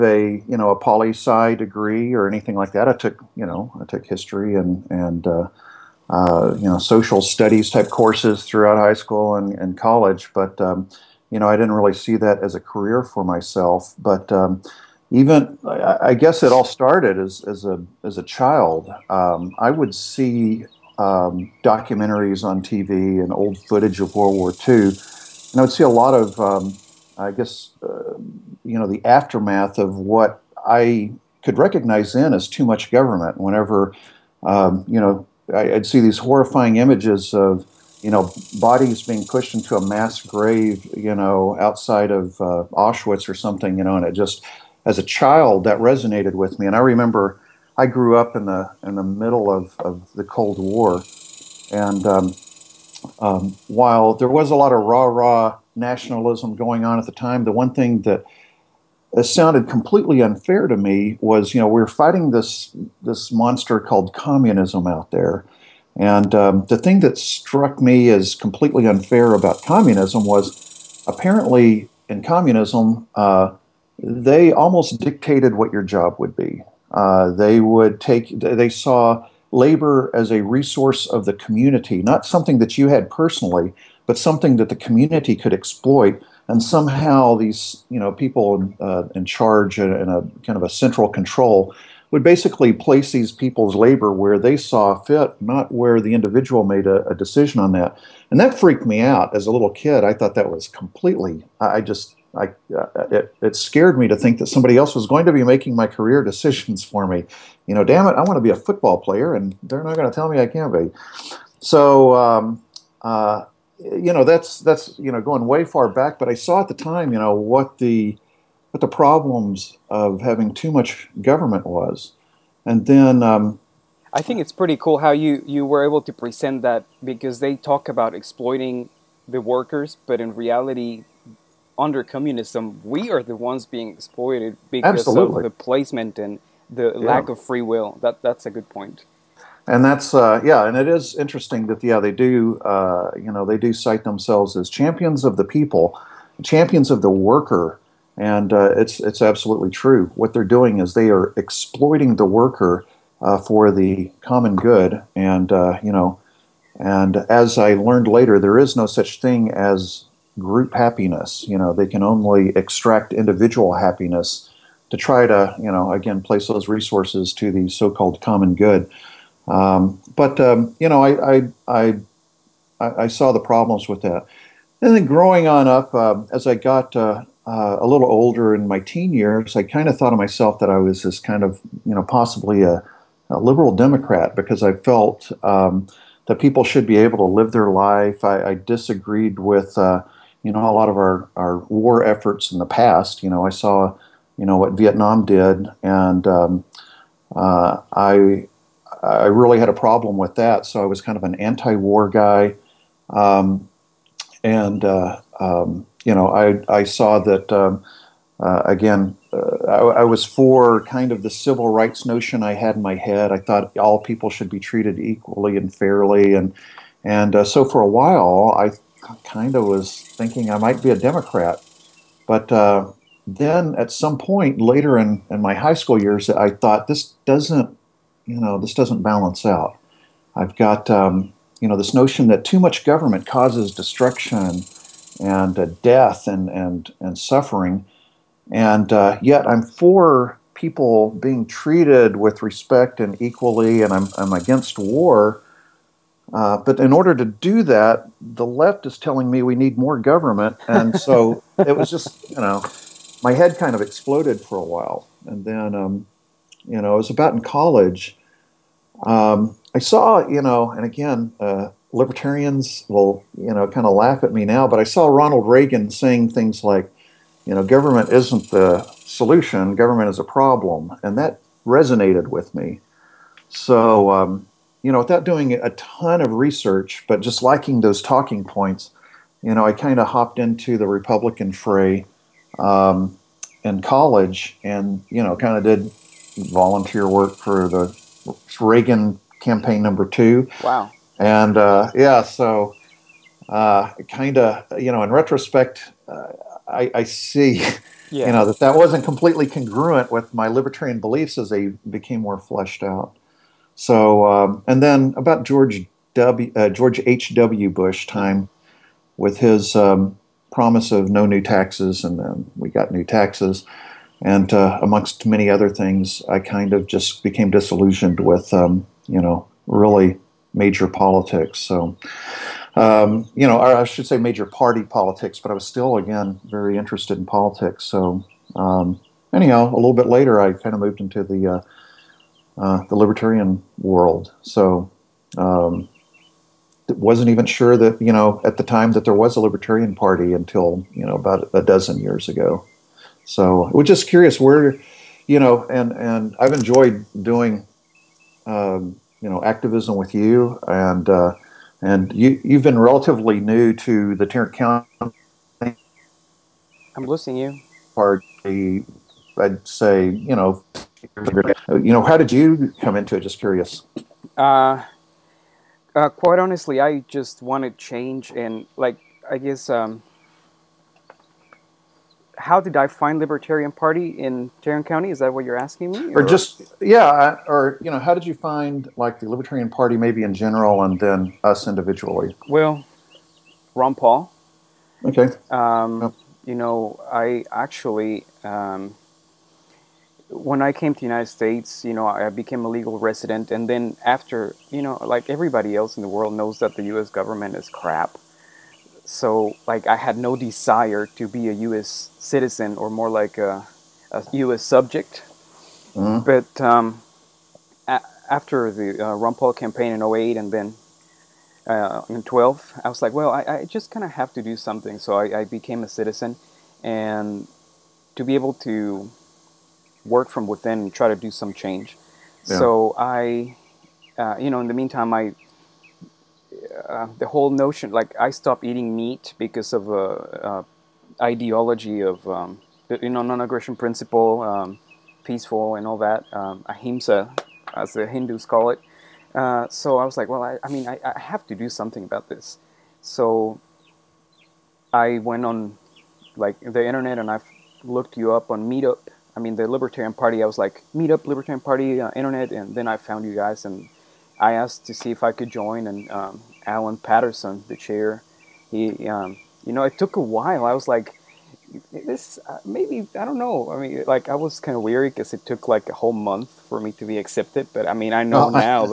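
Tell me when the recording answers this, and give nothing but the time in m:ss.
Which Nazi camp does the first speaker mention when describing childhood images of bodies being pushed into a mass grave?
0:42.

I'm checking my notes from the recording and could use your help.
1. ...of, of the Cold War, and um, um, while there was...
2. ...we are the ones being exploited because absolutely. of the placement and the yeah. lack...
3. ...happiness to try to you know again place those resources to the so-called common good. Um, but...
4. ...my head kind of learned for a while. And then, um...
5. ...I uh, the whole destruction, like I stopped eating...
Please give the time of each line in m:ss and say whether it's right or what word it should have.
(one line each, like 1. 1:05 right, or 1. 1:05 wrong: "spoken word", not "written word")
1. 0:49 right
2. 2:12 right
3. 2:43 right
4. 4:13 wrong: "exploded", not "learned"
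5. 7:05 wrong: "notion", not "destruction".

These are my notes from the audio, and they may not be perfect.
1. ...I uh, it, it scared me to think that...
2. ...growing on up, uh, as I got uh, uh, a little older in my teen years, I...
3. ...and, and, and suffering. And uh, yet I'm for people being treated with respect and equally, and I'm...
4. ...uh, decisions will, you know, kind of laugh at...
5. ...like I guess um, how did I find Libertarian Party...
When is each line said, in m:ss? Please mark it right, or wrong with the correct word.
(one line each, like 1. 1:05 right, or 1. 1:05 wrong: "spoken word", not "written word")
1. 1:42 right
2. 2:55 right
3. 3:56 right
4. 4:21 wrong: "libertarians", not "decisions"
5. 6:08 right.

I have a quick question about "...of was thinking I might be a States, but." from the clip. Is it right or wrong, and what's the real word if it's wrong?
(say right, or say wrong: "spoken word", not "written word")
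wrong: "Democrat", not "States".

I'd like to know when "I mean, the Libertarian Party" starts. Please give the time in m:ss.
7:29.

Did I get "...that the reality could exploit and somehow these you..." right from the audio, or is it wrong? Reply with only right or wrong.
wrong.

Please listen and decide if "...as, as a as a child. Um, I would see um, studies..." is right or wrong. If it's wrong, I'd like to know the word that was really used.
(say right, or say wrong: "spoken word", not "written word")
wrong: "documentaries", not "studies".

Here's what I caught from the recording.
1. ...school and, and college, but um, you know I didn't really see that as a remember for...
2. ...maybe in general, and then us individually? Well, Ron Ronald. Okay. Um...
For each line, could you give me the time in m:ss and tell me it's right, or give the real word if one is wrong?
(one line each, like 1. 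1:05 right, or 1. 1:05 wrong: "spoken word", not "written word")
1. 0:08 wrong: "career", not "remember"
2. 6:19 wrong: "Paul", not "Ronald".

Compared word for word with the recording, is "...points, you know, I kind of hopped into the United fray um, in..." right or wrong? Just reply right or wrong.
wrong.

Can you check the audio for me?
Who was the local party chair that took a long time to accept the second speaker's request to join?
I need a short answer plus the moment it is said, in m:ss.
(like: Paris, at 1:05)
Alan Patterson, at 7:36.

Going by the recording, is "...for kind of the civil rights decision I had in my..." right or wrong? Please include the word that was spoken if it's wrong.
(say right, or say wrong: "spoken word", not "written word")
wrong: "notion", not "decision".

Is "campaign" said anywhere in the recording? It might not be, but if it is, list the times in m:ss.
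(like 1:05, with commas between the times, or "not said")
4:49, 6:49.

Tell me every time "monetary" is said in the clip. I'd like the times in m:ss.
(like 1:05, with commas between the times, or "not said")
not said.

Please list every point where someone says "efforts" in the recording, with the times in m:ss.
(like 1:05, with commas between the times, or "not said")
3:12.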